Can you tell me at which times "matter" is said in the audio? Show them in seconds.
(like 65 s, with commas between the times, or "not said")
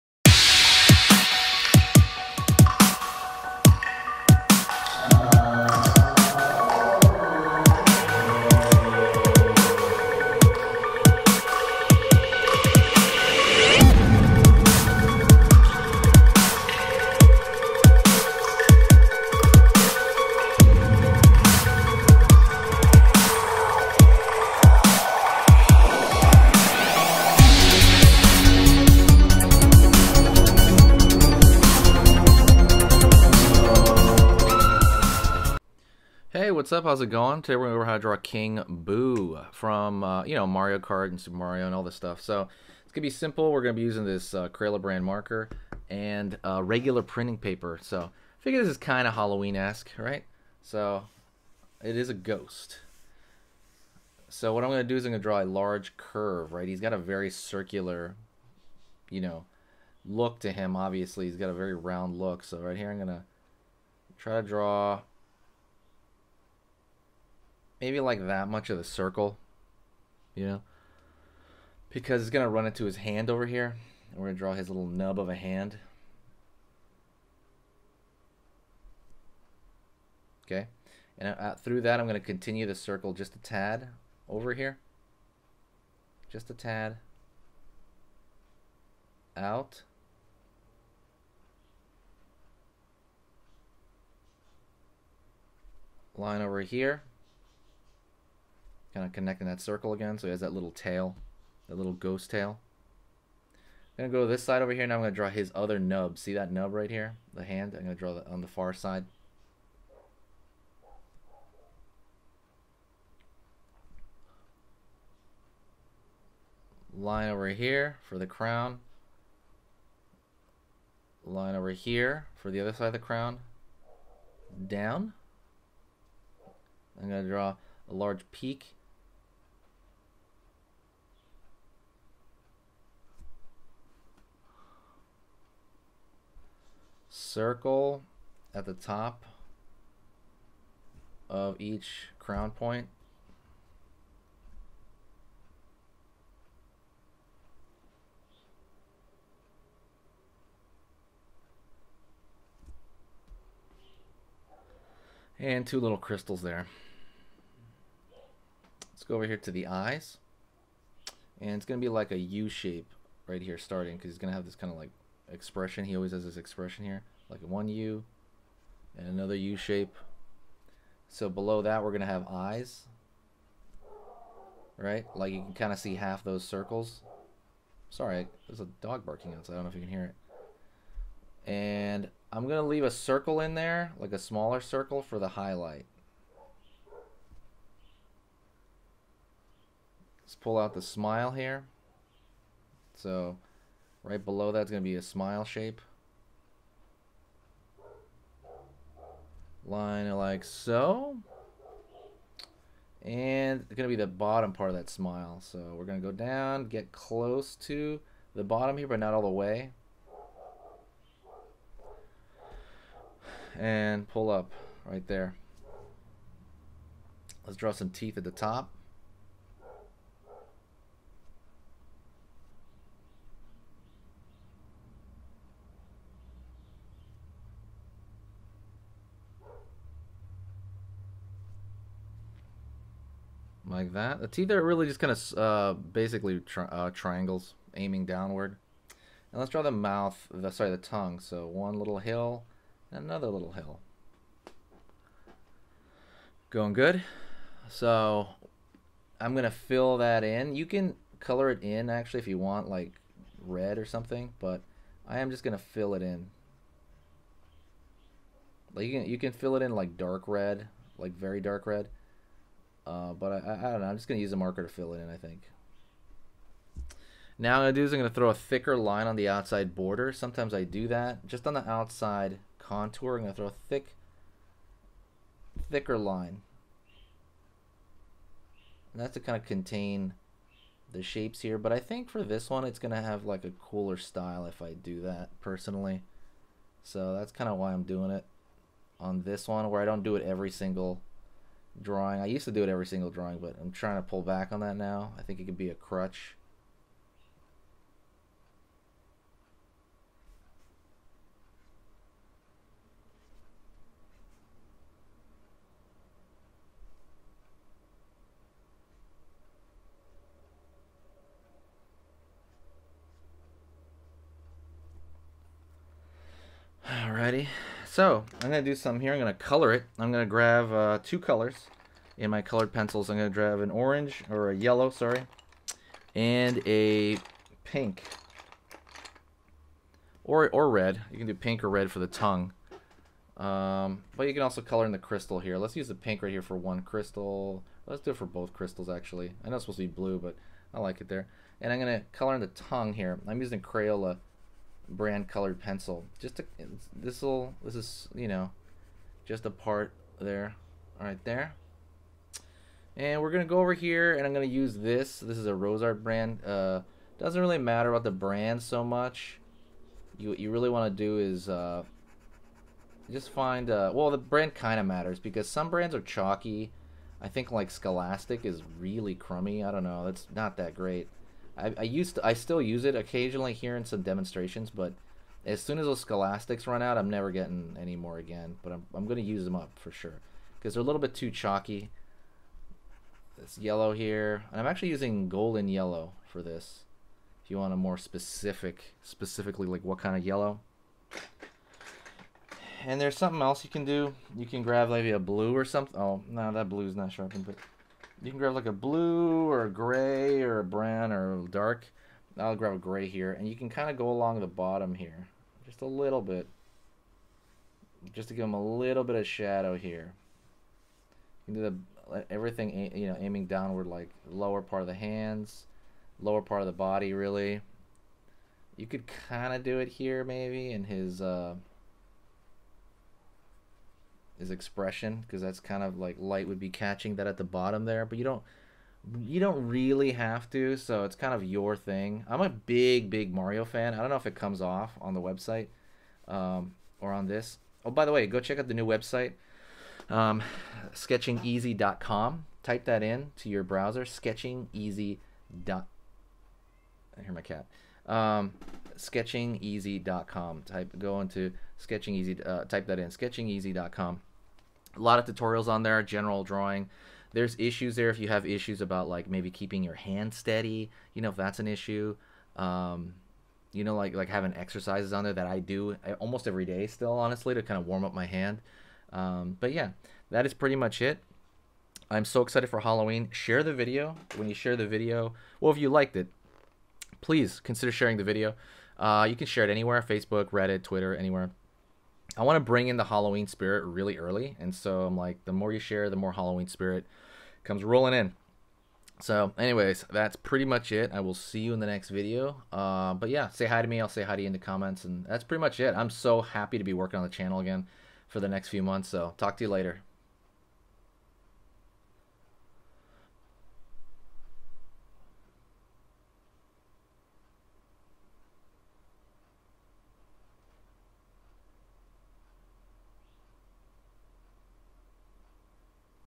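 357 s, 364 s.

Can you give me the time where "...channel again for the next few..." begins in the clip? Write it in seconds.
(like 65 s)
497 s.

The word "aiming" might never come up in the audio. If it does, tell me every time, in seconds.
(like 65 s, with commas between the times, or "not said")
237 s, 413 s.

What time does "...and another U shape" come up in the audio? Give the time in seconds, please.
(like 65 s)
168 s.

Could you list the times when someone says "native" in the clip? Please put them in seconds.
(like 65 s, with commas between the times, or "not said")
not said.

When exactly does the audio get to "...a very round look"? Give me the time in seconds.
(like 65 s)
61 s.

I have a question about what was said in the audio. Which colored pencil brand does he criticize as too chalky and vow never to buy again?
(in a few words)
Scholastic.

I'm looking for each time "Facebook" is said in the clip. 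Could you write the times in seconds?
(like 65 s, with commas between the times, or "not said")
480 s.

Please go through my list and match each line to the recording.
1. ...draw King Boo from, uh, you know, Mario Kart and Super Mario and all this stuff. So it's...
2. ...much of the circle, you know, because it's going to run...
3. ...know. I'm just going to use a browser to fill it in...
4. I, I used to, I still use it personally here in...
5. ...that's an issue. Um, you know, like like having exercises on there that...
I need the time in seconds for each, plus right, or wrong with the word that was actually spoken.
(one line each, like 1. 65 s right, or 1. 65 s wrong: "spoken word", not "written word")
1. 37 s right
2. 68 s right
3. 263 s wrong: "marker", not "browser"
4. 371 s wrong: "occasionally", not "personally"
5. 461 s right.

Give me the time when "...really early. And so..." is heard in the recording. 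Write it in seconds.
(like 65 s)
483 s.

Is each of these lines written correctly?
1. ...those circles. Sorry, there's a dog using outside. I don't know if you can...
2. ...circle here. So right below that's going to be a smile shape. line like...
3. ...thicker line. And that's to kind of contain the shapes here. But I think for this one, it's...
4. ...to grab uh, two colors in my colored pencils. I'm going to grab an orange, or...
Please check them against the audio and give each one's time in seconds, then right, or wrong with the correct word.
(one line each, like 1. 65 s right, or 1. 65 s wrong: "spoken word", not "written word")
1. 176 s wrong: "barking", not "using"
2. 190 s wrong: "smile", not "circle"
3. 275 s right
4. 320 s right.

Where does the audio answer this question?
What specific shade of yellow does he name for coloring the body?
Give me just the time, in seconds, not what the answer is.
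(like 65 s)
385 s.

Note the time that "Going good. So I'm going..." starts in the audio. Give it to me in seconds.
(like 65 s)
246 s.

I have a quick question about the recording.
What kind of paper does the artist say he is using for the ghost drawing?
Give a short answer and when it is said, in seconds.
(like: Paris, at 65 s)
Regular printing paper, at 46 s.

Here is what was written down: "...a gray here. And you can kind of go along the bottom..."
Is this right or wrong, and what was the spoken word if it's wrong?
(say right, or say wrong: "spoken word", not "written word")
right.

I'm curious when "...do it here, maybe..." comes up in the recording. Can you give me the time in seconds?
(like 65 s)
419 s.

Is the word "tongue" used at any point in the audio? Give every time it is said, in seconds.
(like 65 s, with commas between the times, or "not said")
240 s, 332 s, 342 s.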